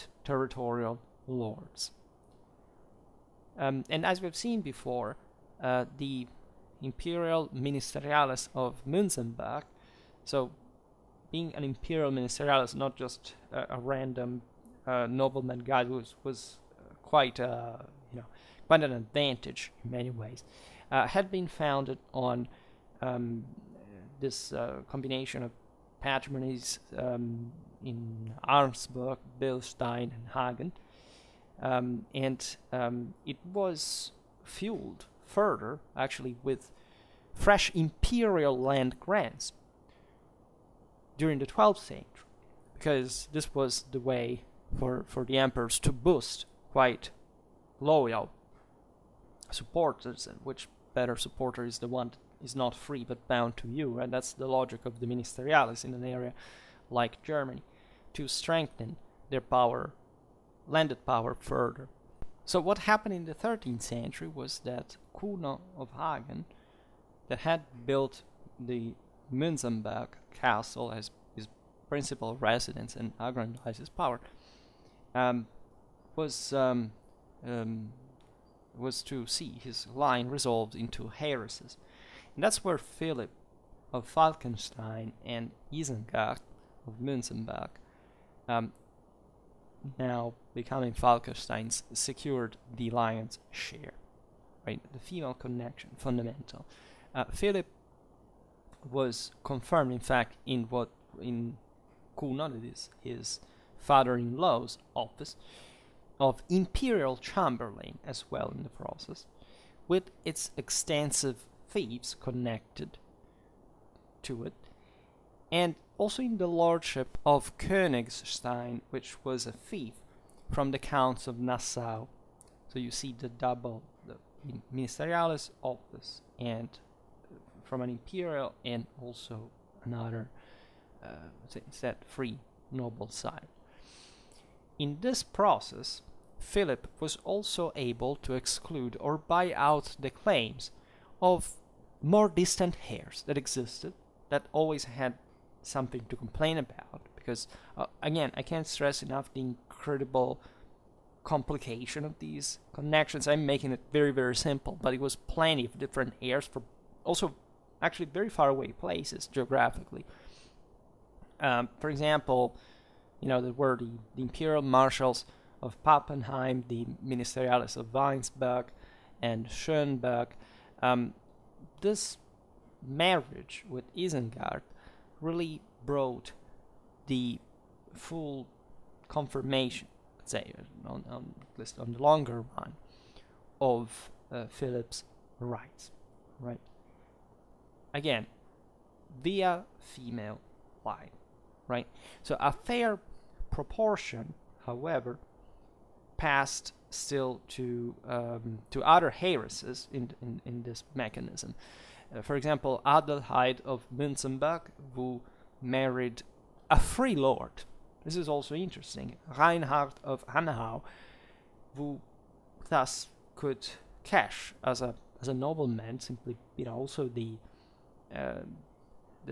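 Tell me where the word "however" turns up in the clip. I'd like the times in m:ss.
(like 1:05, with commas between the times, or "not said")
3:14.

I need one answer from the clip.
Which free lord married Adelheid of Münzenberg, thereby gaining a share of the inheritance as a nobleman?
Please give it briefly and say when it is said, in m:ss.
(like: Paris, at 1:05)
Reinhard of Hanau, at 3:29.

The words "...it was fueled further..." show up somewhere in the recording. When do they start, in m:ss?
0:33.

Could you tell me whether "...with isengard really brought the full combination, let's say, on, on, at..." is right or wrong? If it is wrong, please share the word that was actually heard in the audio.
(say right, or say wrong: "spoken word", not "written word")
wrong: "confirmation", not "combination".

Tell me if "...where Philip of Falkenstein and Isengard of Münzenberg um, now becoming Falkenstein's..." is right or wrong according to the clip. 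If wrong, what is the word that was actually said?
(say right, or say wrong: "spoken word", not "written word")
right.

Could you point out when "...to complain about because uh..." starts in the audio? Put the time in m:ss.
2:26.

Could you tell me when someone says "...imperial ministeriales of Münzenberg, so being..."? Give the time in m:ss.
0:06.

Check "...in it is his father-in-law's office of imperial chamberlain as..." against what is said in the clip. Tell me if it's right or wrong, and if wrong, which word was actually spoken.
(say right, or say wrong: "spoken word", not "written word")
right.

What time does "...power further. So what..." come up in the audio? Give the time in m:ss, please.
1:01.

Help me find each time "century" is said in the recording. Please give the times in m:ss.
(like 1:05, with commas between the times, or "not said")
0:41, 1:03.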